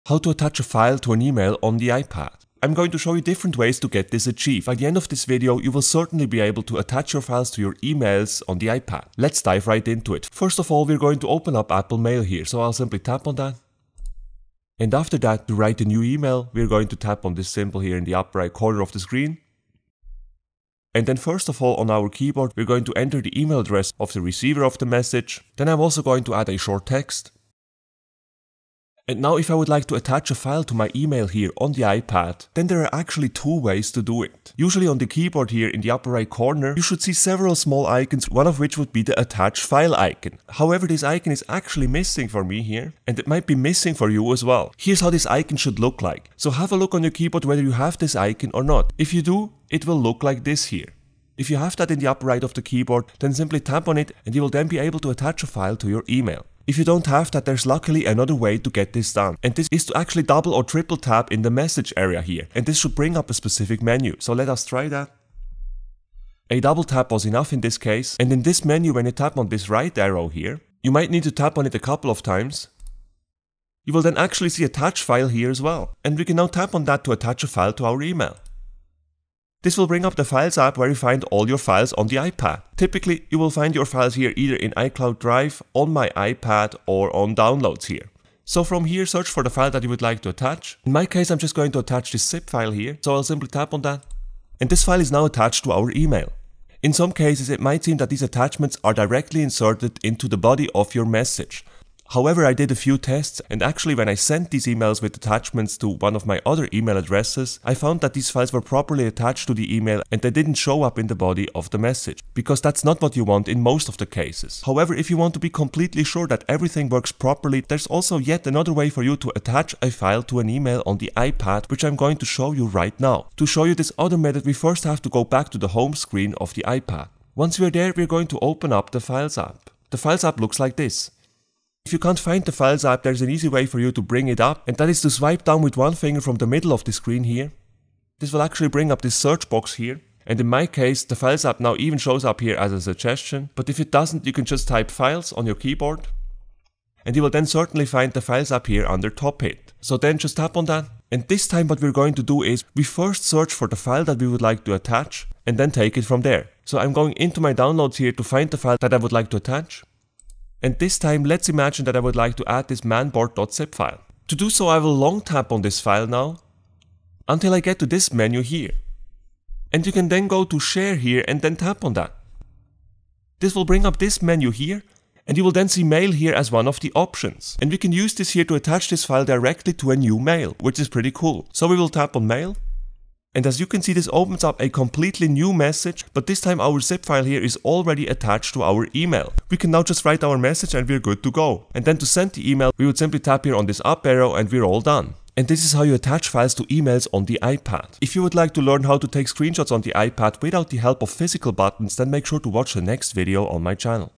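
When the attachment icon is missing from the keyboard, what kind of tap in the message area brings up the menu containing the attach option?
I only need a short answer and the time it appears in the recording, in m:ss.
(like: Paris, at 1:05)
Double tap, at 1:06.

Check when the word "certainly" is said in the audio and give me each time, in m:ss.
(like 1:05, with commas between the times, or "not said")
0:05, 2:27.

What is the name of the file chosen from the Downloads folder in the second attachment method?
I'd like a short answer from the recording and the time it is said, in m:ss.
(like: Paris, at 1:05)
manboard.zip, at 2:42.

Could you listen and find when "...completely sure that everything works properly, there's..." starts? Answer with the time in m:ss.
1:55.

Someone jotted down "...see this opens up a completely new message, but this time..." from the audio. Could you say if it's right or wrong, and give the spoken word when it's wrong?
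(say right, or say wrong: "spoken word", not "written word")
right.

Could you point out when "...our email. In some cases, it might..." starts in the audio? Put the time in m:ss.
1:35.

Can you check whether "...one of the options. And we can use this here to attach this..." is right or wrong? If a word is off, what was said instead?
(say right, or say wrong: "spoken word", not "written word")
right.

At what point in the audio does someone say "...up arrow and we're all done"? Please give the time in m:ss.
3:13.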